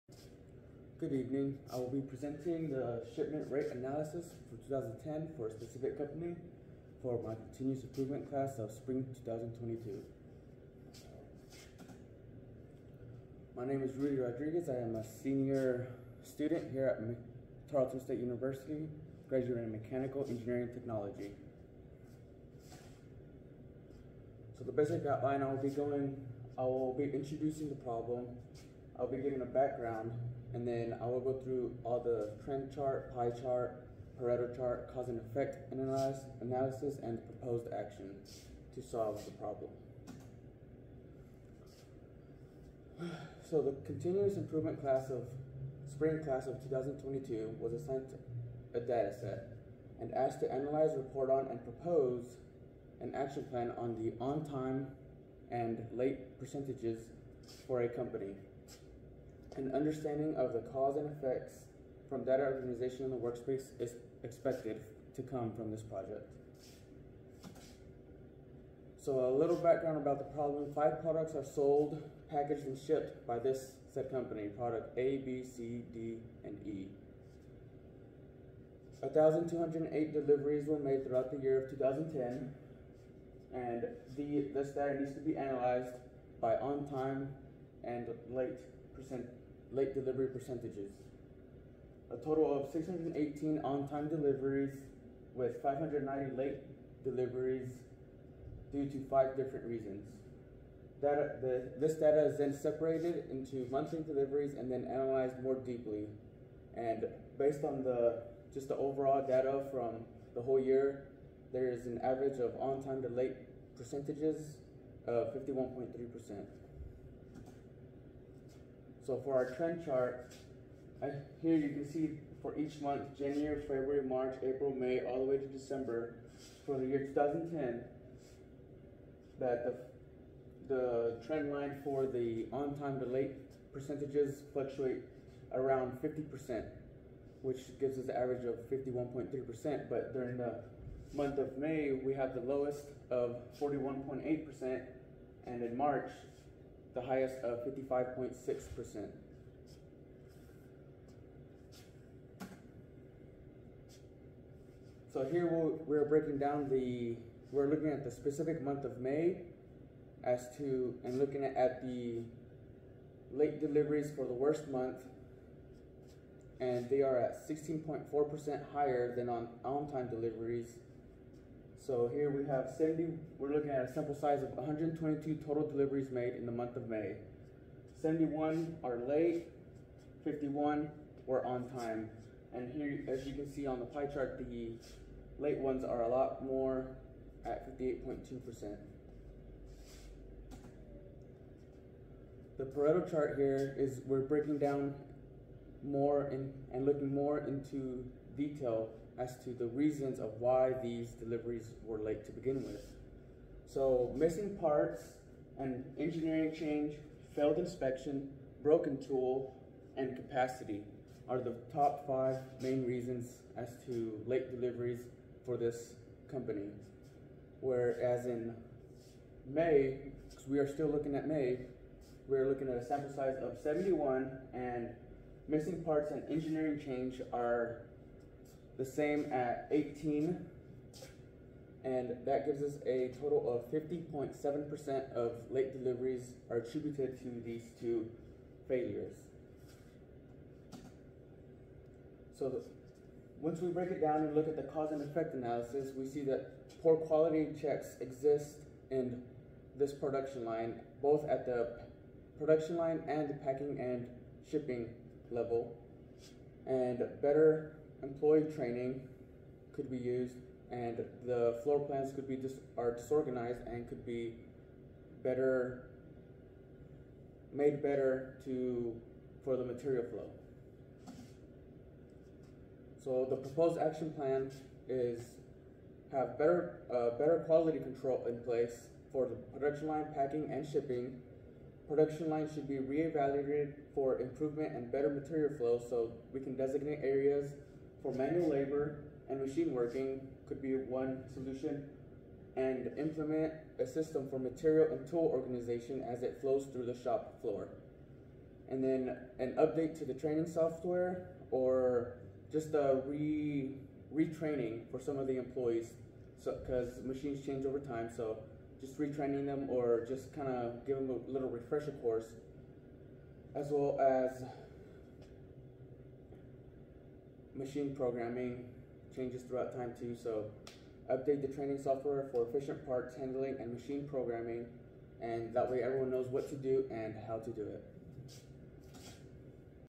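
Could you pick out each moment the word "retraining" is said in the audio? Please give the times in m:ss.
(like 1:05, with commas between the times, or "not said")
5:04, 5:08.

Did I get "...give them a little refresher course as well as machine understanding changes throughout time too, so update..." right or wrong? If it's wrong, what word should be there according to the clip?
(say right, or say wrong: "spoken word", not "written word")
wrong: "programming", not "understanding".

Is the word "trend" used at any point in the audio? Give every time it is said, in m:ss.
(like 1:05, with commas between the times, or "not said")
0:32, 1:59, 2:11.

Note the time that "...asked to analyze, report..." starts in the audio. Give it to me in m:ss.
0:50.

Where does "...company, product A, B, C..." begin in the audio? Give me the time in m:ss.
1:14.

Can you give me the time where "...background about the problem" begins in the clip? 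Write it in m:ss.
1:09.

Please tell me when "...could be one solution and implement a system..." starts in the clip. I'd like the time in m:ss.
4:50.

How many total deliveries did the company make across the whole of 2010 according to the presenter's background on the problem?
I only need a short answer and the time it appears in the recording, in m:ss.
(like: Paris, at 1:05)
1,208, at 1:19.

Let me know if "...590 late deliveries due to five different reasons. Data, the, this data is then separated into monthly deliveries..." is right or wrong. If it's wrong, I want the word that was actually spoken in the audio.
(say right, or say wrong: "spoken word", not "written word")
right.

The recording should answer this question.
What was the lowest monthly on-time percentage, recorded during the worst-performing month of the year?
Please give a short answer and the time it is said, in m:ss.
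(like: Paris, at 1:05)
41.8%, at 2:23.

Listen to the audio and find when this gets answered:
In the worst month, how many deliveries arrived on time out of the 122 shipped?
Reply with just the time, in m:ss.
3:00.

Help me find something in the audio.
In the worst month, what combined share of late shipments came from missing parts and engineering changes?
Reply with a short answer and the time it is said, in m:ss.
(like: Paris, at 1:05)
50.7%, at 3:53.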